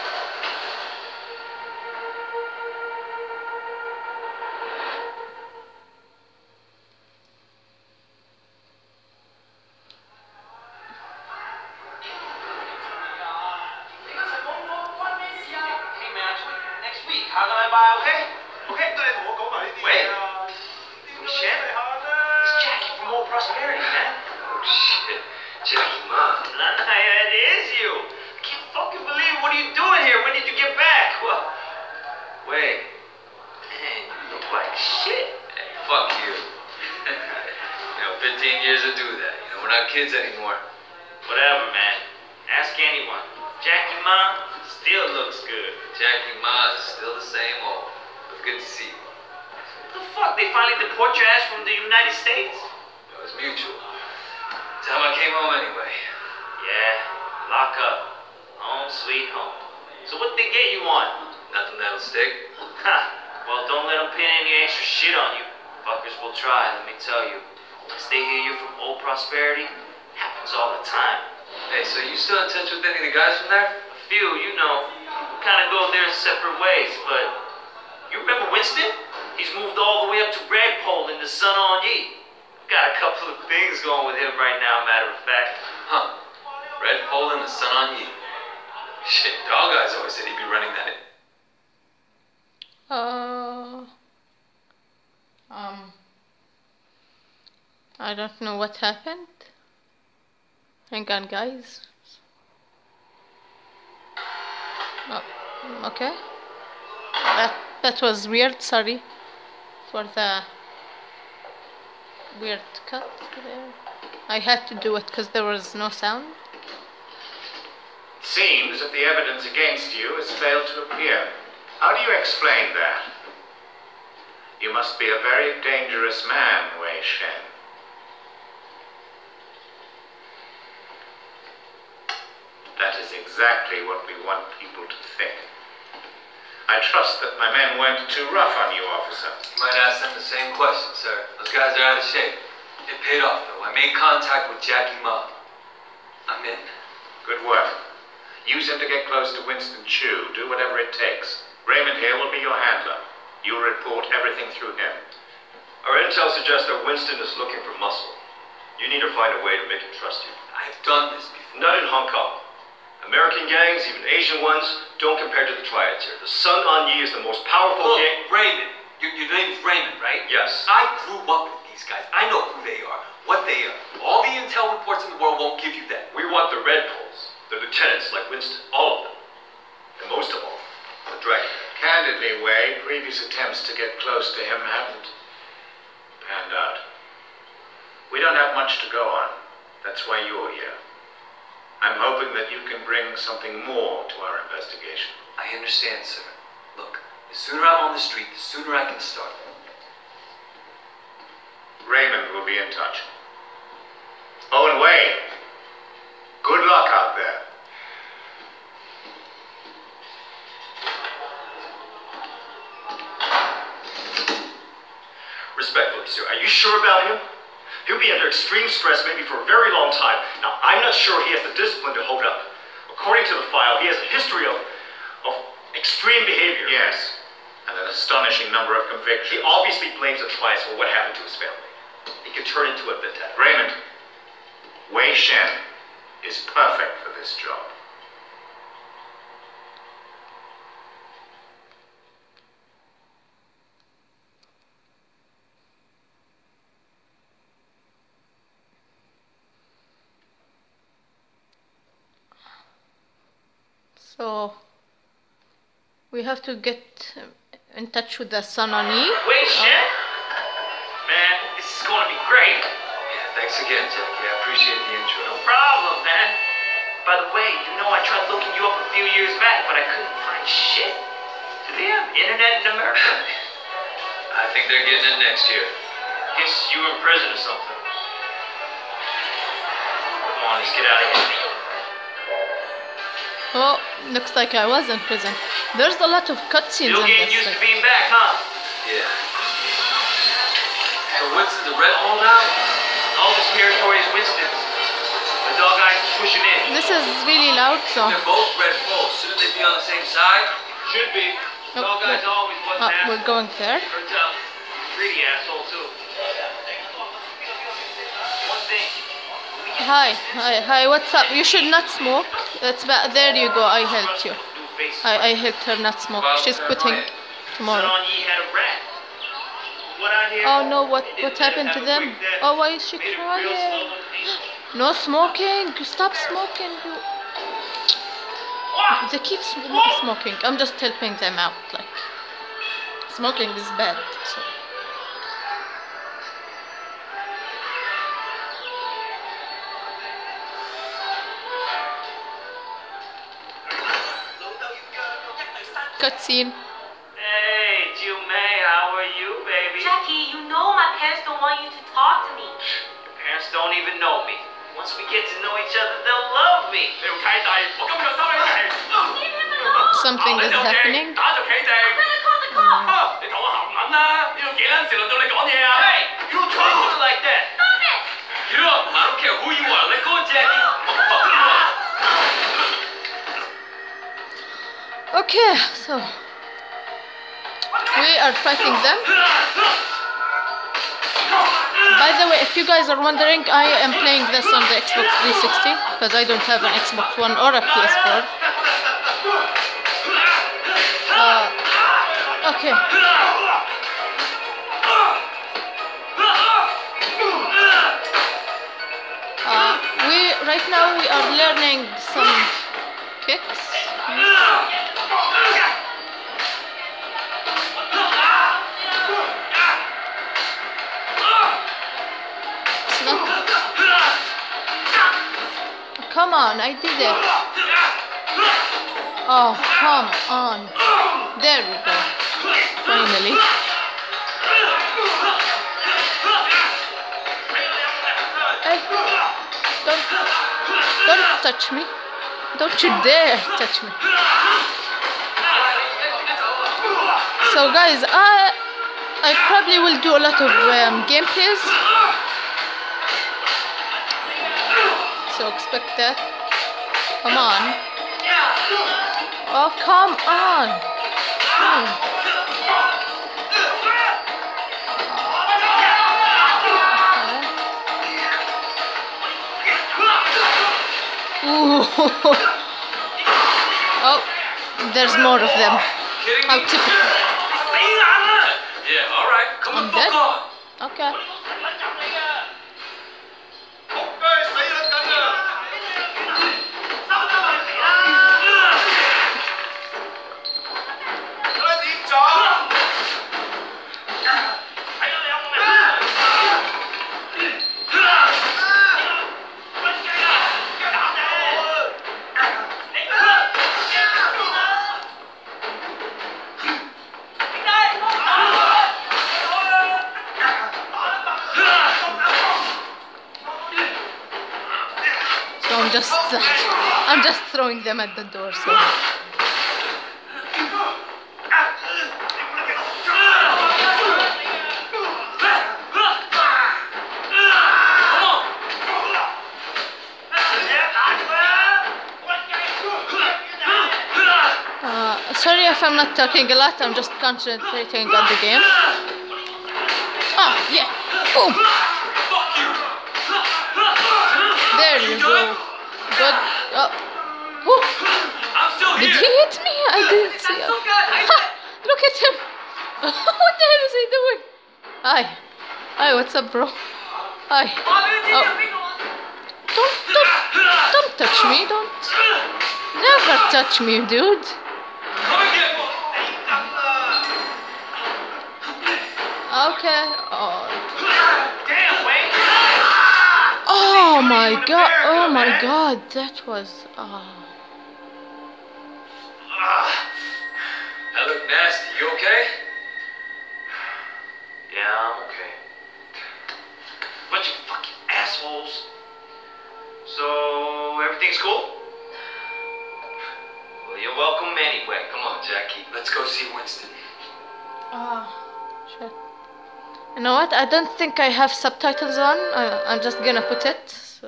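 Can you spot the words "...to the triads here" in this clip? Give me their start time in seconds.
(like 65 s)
165 s.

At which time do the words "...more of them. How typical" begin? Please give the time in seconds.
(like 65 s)
465 s.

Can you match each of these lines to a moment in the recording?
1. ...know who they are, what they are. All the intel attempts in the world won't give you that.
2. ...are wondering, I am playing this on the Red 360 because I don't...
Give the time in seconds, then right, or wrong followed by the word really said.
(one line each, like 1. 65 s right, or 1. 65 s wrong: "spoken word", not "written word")
1. 172 s wrong: "reports", not "attempts"
2. 382 s wrong: "Xbox", not "Red".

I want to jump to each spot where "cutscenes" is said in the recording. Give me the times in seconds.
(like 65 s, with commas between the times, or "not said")
286 s, 346 s.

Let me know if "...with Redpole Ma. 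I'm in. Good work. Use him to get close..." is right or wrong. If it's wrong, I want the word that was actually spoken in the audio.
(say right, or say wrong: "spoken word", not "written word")
wrong: "Jackie", not "Redpole".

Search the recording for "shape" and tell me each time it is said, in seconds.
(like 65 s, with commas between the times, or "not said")
142 s.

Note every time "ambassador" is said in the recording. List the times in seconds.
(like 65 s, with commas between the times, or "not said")
not said.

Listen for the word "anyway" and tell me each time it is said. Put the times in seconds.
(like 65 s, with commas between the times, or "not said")
55 s, 584 s.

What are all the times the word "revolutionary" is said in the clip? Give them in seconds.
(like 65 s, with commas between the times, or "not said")
not said.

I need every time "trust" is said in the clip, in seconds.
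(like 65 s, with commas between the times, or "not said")
136 s, 159 s.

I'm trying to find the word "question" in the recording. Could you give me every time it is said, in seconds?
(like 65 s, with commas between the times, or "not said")
140 s.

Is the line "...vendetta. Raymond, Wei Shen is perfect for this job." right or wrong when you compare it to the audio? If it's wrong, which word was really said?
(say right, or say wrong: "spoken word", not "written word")
right.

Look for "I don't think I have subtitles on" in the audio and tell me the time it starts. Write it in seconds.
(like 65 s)
590 s.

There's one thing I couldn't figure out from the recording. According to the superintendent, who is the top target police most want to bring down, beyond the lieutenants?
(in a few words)
The Dragon.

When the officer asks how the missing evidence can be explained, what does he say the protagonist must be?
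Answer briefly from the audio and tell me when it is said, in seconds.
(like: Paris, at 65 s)
A very dangerous man, at 125 s.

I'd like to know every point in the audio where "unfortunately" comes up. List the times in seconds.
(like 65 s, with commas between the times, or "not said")
not said.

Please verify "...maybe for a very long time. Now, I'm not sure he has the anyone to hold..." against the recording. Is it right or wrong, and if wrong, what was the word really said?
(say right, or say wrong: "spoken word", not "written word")
wrong: "discipline", not "anyone".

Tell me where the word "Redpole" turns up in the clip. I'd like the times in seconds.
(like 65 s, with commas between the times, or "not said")
80 s, 86 s.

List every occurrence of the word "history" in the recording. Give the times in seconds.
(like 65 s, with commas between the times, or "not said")
224 s.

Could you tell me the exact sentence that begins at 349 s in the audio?
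Jackie, you know my parents don't want you to talk to me.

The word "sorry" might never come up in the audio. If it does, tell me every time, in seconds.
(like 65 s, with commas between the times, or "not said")
108 s, 525 s.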